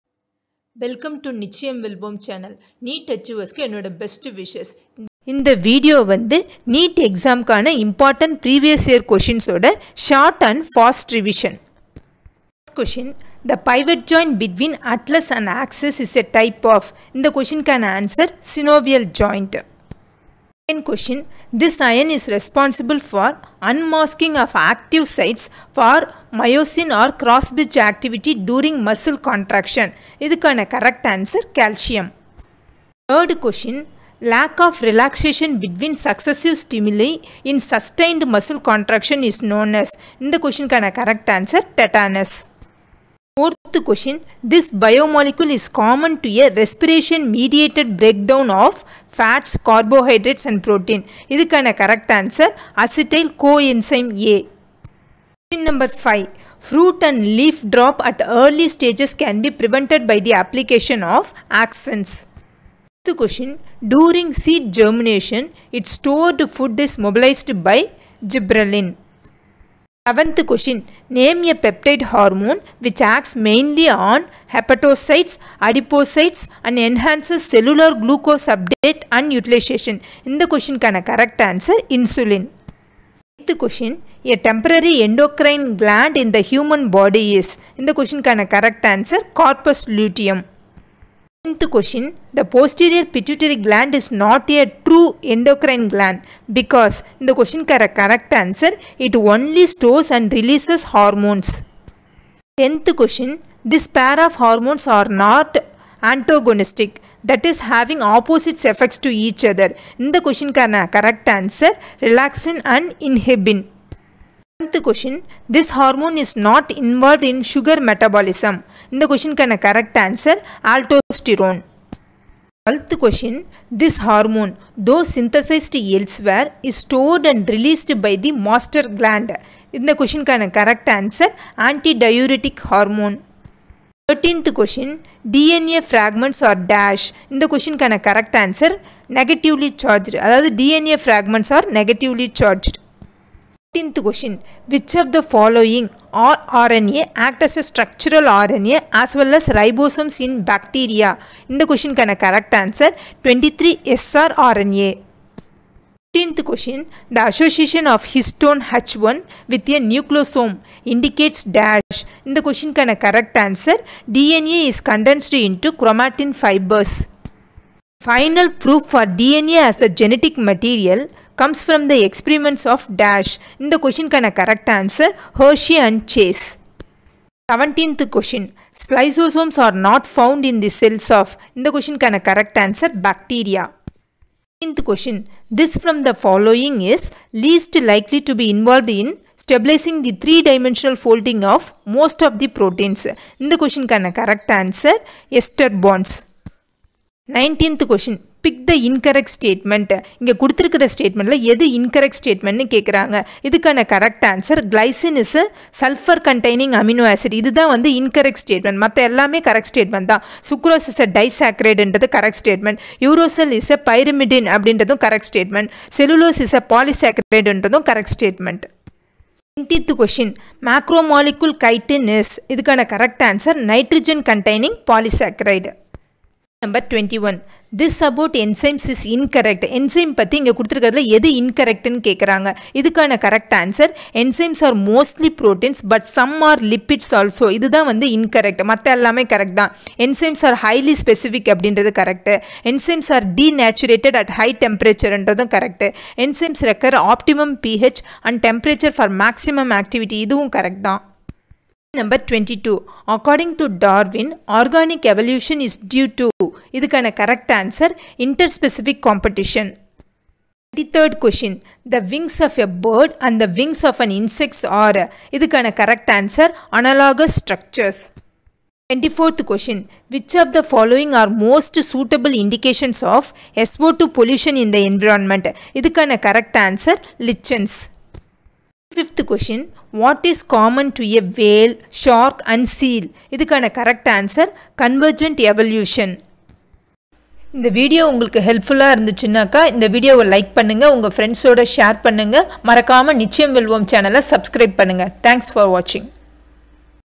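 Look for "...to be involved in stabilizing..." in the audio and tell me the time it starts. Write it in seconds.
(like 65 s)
188 s.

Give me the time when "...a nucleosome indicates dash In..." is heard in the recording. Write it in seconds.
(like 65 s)
159 s.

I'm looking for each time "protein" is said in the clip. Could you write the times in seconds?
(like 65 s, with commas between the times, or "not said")
50 s, 192 s.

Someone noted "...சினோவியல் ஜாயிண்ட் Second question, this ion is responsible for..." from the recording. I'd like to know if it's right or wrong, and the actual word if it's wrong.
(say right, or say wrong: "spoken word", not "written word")
right.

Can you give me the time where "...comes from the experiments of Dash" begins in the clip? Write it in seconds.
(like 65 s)
171 s.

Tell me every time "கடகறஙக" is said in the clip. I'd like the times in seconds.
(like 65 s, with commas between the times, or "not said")
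202 s, 232 s.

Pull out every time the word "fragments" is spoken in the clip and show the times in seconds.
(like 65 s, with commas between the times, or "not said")
135 s, 140 s.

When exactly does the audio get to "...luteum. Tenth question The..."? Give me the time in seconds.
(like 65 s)
89 s.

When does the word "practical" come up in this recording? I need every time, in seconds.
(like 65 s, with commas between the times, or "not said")
not said.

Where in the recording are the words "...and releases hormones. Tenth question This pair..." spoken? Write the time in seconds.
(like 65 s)
100 s.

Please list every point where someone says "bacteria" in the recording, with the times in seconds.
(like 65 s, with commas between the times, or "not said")
150 s, 183 s.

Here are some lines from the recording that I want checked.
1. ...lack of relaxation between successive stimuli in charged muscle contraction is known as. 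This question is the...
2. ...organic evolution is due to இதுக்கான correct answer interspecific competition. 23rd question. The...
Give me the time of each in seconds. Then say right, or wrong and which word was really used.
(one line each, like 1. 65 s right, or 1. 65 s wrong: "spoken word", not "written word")
1. 34 s wrong: "sustained", not "charged"
2. 254 s right.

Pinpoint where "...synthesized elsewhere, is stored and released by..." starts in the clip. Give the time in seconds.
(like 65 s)
125 s.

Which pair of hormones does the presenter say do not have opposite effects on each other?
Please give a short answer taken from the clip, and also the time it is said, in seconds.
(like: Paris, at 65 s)
relaxin and inhibin, at 112 s.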